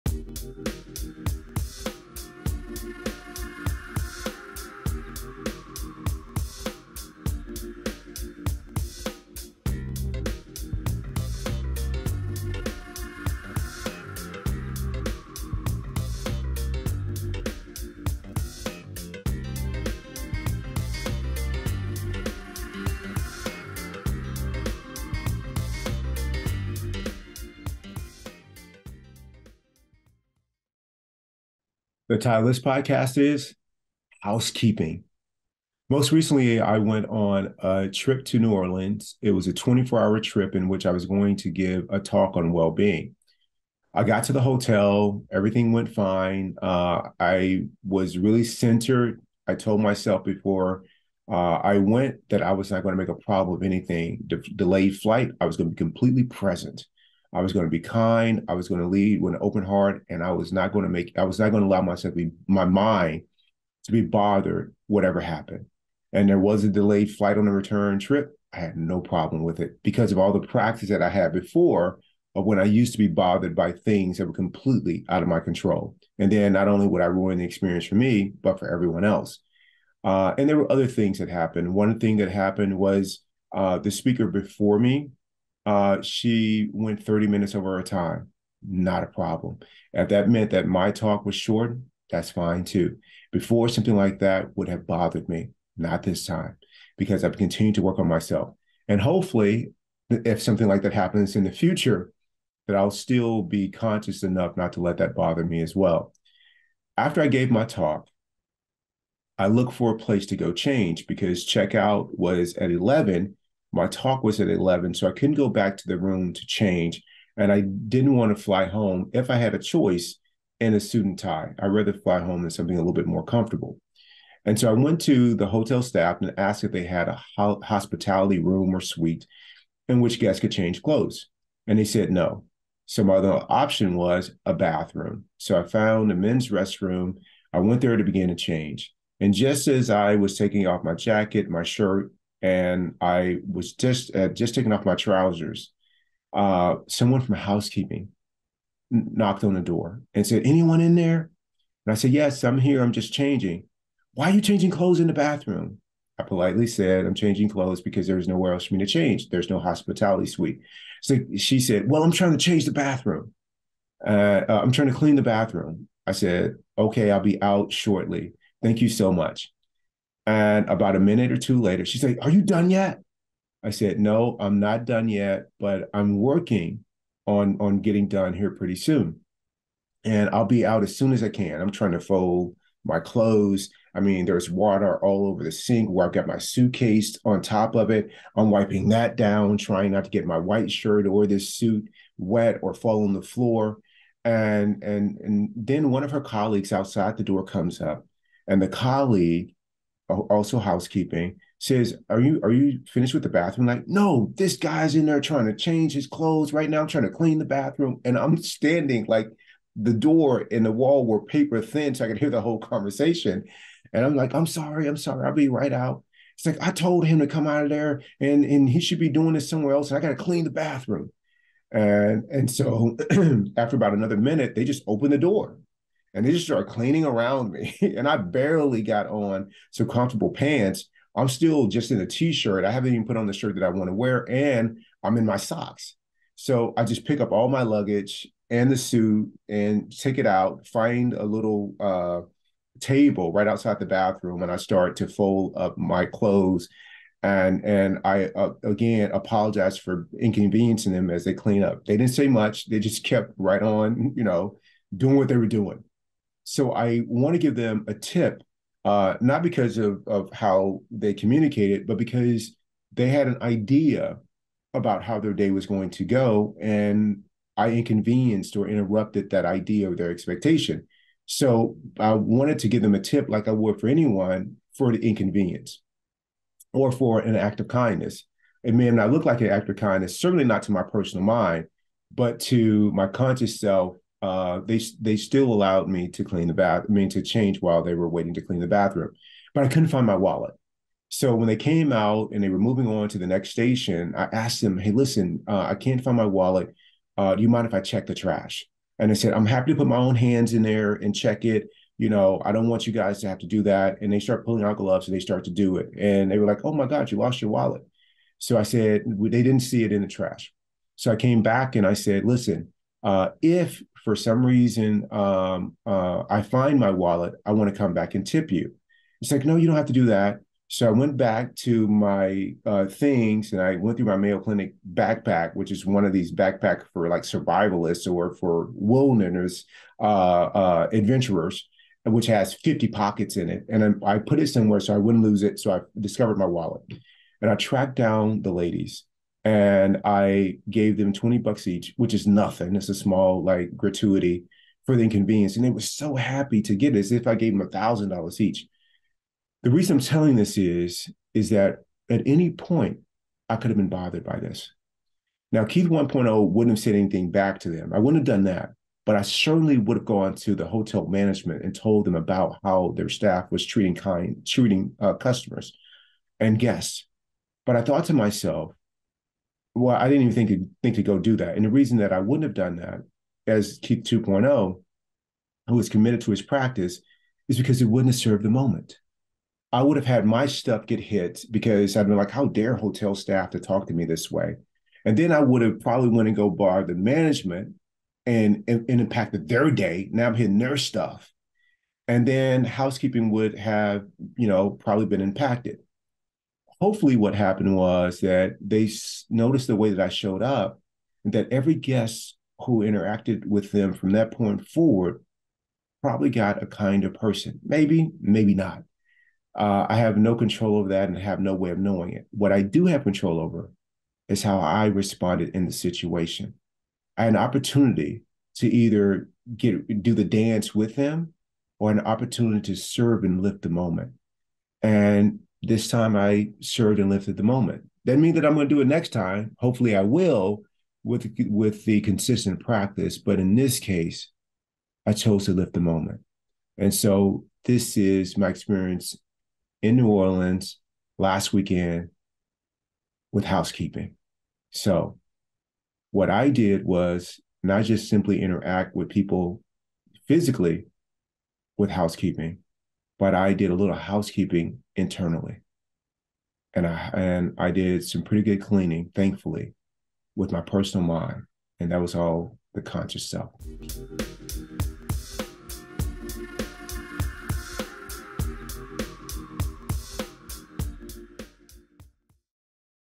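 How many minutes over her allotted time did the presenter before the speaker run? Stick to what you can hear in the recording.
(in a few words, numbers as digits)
30.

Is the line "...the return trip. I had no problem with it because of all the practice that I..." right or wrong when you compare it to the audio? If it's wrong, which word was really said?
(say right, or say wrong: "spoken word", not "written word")
right.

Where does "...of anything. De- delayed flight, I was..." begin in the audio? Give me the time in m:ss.
0:53.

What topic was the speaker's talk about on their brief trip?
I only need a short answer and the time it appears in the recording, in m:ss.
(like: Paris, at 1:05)
Well being, at 0:42.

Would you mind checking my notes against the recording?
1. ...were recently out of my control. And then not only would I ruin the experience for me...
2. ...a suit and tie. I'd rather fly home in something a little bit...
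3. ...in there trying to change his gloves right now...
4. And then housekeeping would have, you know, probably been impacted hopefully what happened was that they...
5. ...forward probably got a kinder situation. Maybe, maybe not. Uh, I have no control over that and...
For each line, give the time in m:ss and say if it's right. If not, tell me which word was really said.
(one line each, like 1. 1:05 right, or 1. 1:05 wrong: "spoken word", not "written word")
1. 1:14 wrong: "completely", not "recently"
2. 2:00 right
3. 3:24 wrong: "clothes", not "gloves"
4. 6:32 right
5. 6:44 wrong: "person", not "situation".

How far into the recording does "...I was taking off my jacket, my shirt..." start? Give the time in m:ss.
2:19.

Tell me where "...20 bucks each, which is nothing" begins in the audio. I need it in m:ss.
5:41.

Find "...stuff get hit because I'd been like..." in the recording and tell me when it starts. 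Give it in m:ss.
6:20.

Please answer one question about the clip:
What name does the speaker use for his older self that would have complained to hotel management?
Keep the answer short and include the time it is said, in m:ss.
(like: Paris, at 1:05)
Keith 1.0, at 5:55.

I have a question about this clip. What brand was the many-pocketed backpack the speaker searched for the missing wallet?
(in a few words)
Mayo Clinic.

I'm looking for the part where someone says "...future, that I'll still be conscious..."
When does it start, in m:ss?
1:41.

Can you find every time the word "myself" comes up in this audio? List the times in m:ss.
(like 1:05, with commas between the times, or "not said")
0:49, 1:01, 1:38, 6:08.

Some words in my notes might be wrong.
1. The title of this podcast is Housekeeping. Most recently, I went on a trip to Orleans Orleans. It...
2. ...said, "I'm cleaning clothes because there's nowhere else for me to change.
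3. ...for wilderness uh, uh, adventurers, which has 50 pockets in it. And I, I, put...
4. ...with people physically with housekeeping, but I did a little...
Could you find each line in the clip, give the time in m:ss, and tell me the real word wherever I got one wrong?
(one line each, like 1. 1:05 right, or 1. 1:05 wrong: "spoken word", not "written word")
1. 0:32 wrong: "New", not "Orleans"
2. 2:36 wrong: "changing", not "cleaning"
3. 5:28 right
4. 7:28 right.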